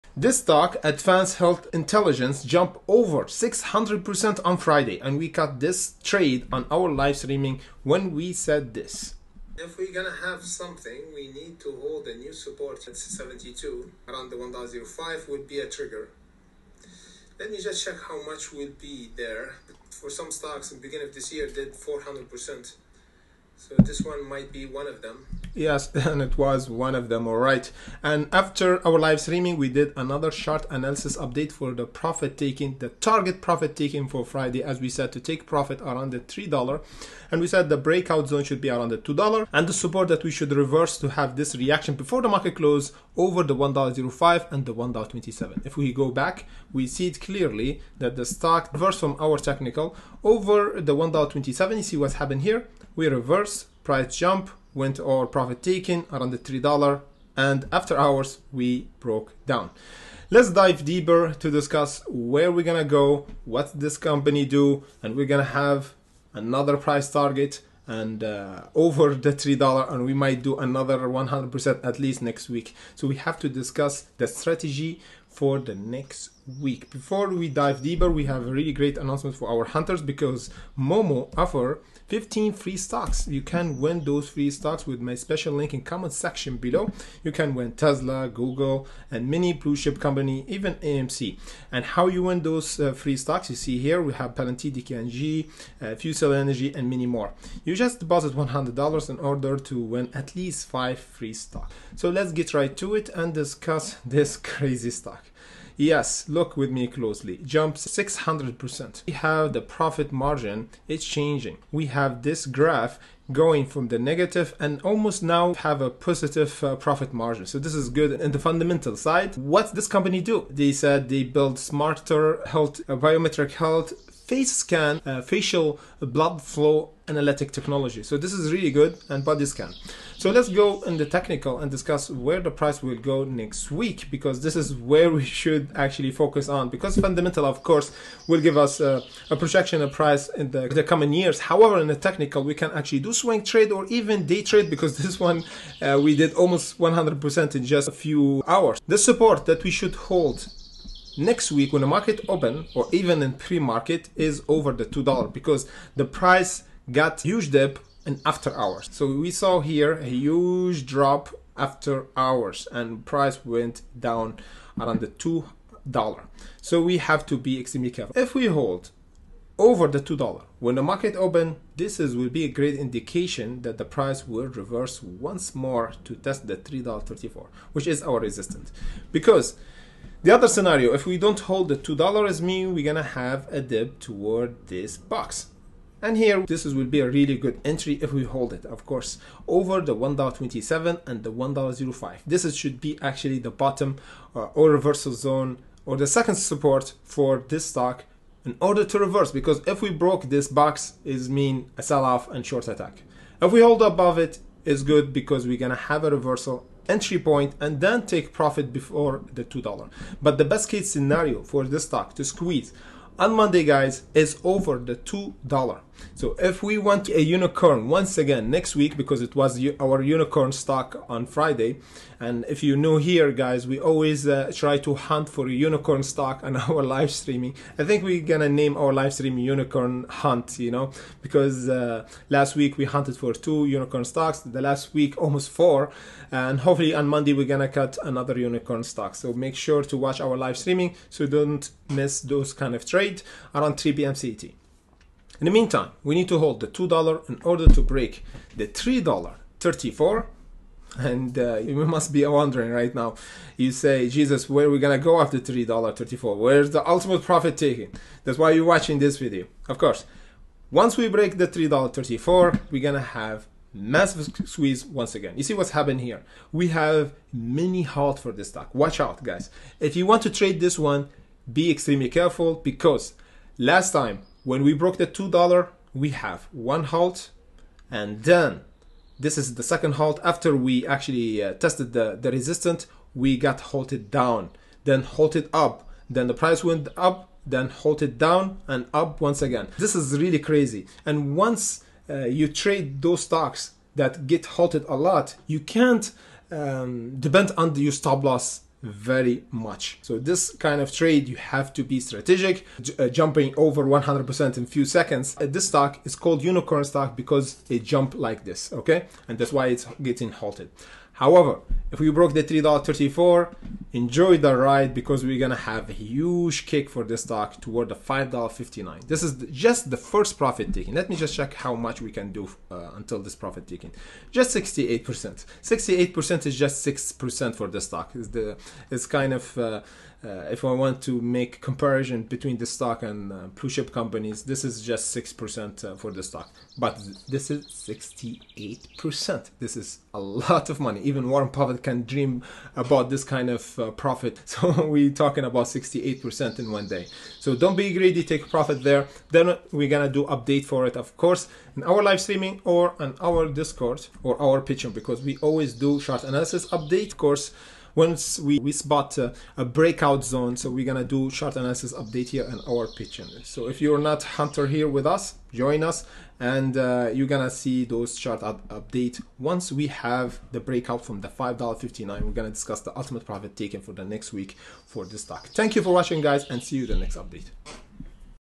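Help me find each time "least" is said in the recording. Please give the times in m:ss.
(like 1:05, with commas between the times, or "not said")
1:11, 1:40.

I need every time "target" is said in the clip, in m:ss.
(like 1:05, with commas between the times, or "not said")
0:32, 1:07.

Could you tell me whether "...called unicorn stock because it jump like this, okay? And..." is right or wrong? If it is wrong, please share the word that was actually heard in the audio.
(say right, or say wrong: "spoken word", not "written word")
right.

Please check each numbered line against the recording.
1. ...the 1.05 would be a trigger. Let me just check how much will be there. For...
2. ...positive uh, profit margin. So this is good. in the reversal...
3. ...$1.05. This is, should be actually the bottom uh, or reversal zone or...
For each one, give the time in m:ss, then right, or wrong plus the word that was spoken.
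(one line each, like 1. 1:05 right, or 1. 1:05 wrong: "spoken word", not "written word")
1. 0:14 right
2. 1:55 wrong: "fundamental", not "reversal"
3. 3:11 right.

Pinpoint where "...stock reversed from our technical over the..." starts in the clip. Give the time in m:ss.
0:48.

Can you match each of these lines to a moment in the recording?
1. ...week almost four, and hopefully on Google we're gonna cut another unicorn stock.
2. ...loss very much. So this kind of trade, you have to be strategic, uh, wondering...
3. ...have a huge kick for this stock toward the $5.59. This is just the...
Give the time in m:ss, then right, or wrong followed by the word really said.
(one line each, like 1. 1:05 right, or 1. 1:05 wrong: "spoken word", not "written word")
1. 3:54 wrong: "Monday", not "Google"
2. 4:58 wrong: "jumping", not "wondering"
3. 5:15 right.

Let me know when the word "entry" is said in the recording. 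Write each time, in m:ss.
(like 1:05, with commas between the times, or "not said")
3:07, 3:26.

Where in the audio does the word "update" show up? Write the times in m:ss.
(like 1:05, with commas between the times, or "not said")
0:31, 5:50, 5:56, 6:01, 6:08, 6:17.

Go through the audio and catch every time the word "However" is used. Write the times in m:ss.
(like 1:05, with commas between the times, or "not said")
2:21, 5:11.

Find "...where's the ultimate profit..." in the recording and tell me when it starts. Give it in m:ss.
4:16.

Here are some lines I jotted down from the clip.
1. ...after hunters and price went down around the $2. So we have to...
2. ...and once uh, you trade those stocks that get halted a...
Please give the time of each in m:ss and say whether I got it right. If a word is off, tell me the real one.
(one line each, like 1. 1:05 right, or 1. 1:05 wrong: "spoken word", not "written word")
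1. 2:41 wrong: "hours", not "hunters"
2. 4:51 right.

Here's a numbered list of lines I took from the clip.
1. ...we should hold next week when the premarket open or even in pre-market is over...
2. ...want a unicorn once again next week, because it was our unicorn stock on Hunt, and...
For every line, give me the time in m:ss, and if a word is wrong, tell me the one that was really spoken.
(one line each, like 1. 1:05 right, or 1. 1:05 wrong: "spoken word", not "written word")
1. 2:29 wrong: "market", not "premarket"
2. 3:36 wrong: "Friday", not "Hunt".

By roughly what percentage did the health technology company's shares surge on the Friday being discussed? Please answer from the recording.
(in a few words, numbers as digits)
600%.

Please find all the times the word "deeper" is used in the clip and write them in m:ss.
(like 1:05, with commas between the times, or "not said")
1:00, 1:17.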